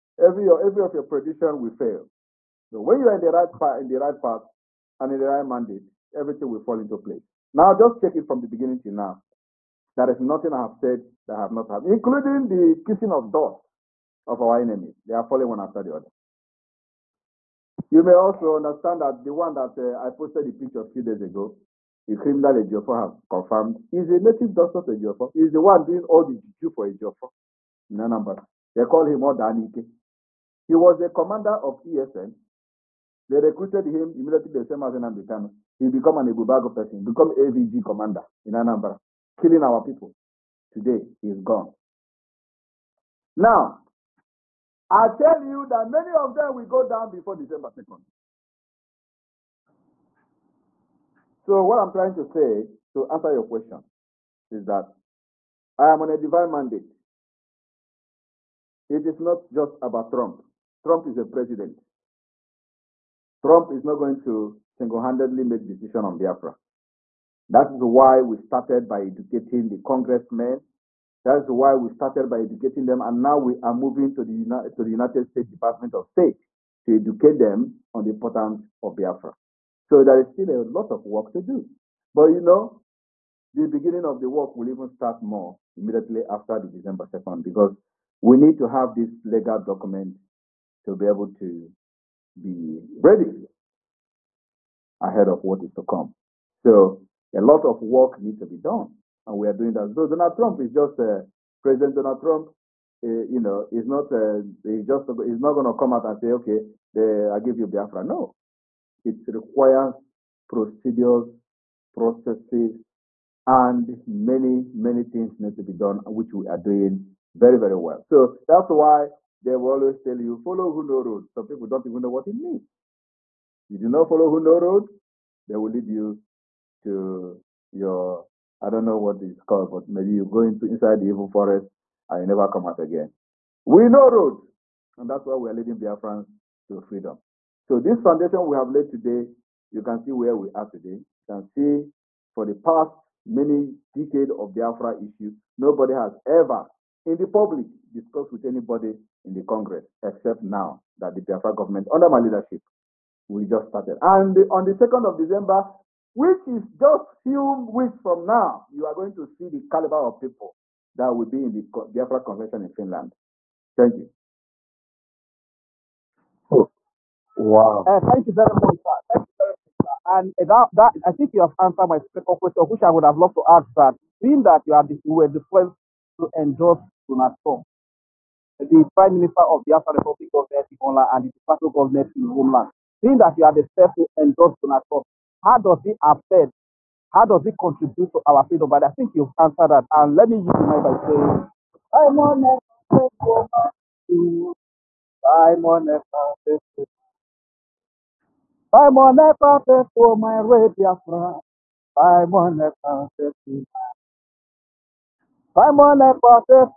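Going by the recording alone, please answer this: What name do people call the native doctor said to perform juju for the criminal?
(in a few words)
Odanike.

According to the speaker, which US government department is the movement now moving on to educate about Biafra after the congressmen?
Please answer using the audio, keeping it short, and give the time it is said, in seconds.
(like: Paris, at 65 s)
Department of State, at 75 s.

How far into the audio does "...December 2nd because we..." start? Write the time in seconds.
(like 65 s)
86 s.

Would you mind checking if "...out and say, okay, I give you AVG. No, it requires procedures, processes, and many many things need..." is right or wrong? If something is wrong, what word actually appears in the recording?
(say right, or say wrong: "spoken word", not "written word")
wrong: "Biafra", not "AVG".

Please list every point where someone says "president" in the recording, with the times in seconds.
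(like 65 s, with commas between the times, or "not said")
61 s, 101 s.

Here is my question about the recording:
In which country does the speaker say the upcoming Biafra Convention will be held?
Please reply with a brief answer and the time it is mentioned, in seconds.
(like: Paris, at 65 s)
Finland, at 162 s.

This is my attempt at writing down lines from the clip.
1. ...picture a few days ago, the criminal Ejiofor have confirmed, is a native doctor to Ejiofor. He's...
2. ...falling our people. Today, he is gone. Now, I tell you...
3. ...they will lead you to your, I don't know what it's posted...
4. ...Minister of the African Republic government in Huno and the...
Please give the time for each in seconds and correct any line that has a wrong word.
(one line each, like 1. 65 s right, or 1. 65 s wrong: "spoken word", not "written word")
1. 20 s right
2. 39 s wrong: "killing", not "falling"
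3. 125 s wrong: "called", not "posted"
4. 179 s wrong: "Holland", not "Huno".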